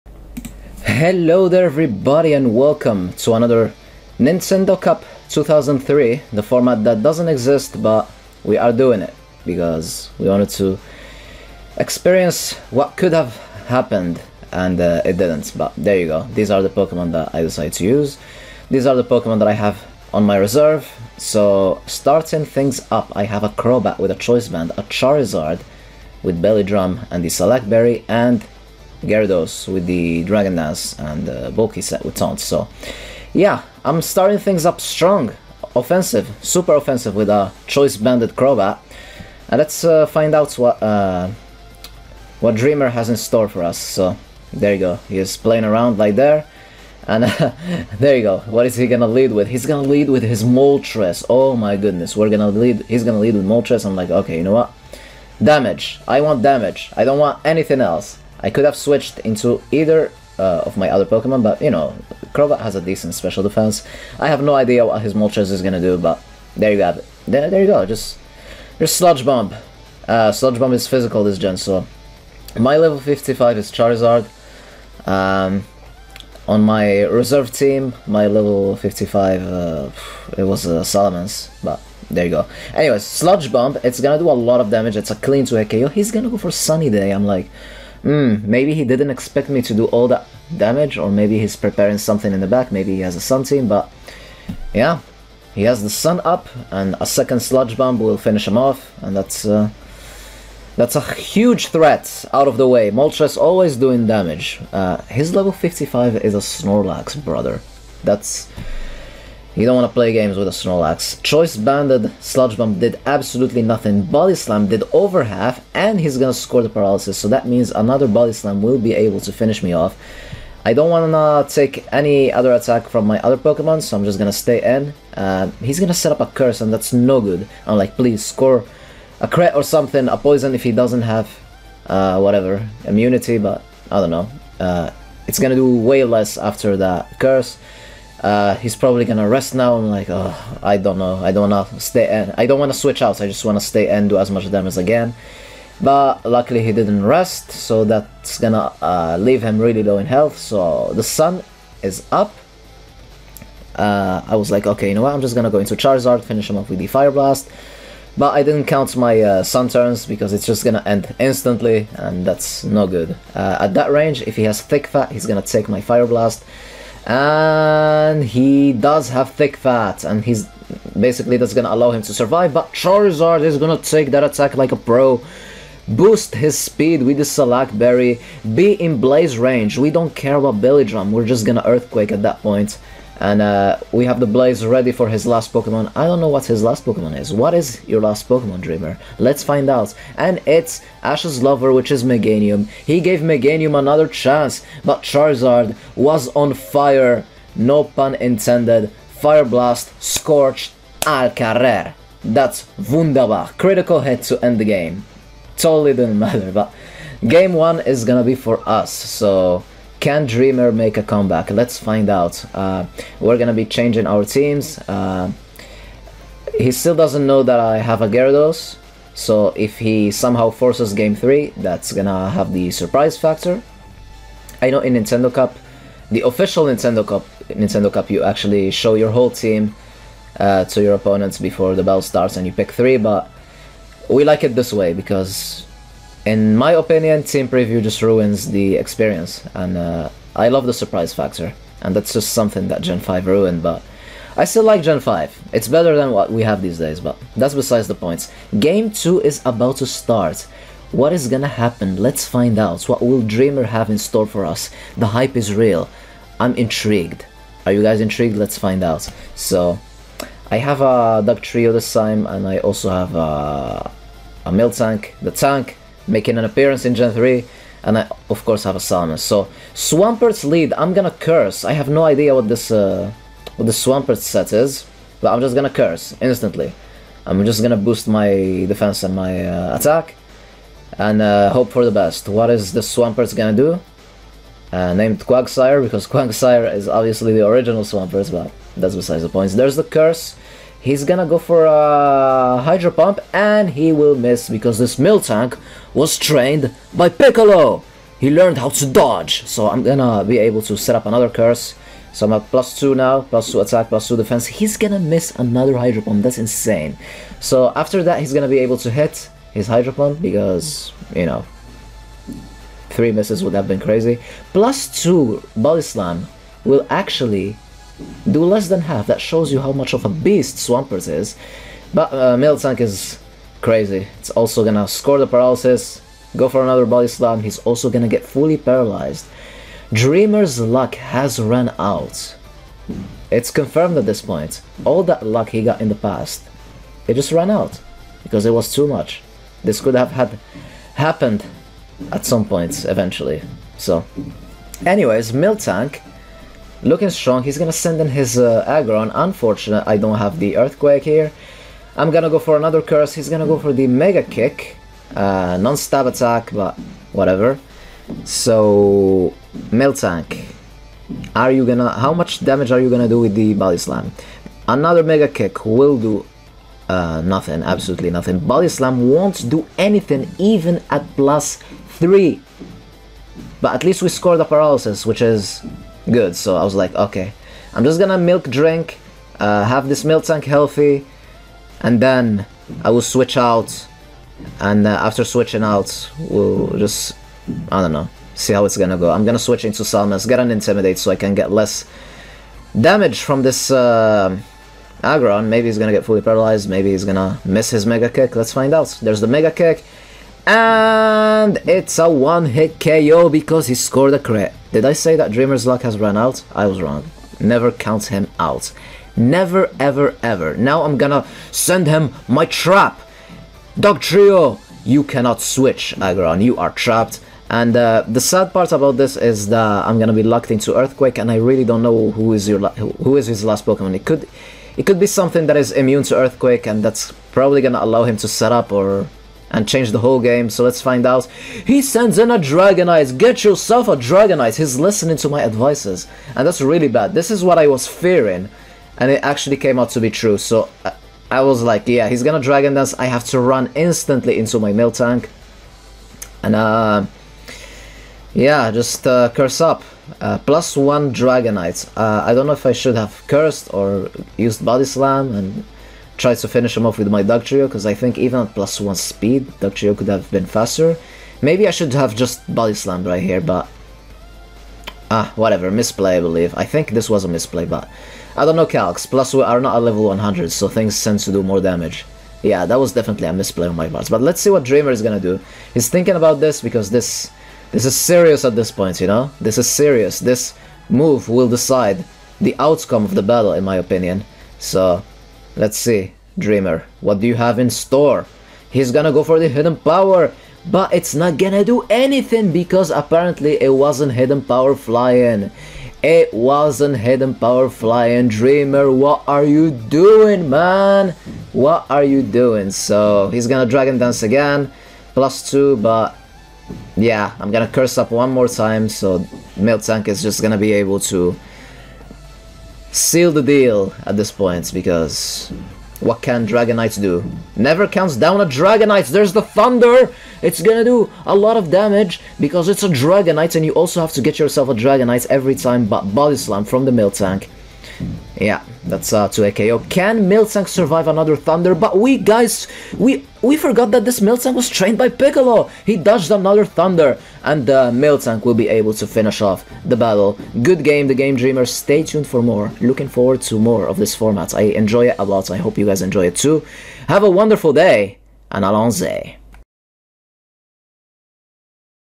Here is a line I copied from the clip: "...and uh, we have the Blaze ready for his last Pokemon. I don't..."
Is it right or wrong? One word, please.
right.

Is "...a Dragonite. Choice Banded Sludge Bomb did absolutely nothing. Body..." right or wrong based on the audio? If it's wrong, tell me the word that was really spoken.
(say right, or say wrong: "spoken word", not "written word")
wrong: "Snorlax", not "Dragonite".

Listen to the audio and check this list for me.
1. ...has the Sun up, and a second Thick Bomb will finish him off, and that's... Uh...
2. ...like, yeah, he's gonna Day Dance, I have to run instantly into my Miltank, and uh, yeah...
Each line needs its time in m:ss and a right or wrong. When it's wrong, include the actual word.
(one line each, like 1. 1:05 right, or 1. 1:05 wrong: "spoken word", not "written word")
1. 1:35 wrong: "Sludge", not "Thick"
2. 7:21 wrong: "Dragon", not "Day".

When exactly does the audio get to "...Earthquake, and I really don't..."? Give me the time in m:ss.
7:00.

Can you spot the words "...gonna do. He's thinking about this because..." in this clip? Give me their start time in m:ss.
7:55.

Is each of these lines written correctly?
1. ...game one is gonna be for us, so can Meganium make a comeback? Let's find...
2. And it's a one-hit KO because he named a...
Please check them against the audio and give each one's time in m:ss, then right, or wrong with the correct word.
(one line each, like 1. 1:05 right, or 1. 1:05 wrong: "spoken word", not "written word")
1. 3:27 wrong: "Dreamer", not "Meganium"
2. 6:40 wrong: "scored", not "named".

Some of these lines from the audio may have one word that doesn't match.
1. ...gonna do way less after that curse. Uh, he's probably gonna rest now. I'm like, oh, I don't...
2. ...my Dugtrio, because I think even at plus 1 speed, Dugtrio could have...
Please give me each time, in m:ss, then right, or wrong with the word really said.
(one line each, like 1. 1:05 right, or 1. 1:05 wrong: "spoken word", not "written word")
1. 2:15 right
2. 7:37 right.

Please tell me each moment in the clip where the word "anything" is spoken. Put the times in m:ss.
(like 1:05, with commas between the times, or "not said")
0:57, 6:09, 8:11.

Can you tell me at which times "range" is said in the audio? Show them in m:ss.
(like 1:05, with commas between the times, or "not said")
2:43, 2:59.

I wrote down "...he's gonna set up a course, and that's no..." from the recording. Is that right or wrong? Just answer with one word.
wrong.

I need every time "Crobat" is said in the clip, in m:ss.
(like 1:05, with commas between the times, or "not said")
0:23, 0:38, 1:02.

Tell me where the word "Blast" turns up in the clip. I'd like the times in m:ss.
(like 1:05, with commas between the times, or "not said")
2:37, 2:46, 3:19.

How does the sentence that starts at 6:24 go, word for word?
And uh, after switching out, we'll just, I don't know, see how it's gonna go.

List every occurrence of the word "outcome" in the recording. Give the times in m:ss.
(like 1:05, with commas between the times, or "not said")
8:02.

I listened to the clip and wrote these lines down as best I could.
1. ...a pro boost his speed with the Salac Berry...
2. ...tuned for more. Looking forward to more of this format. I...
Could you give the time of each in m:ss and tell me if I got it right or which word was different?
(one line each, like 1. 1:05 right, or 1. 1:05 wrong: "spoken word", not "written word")
1. 2:54 right
2. 9:02 right.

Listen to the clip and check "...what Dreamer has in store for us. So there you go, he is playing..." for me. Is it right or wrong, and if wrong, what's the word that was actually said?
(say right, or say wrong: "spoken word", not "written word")
right.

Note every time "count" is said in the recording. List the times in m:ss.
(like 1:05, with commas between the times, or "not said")
2:38, 6:47, 8:37.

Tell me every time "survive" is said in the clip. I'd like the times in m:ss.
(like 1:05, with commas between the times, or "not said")
2:52, 8:50.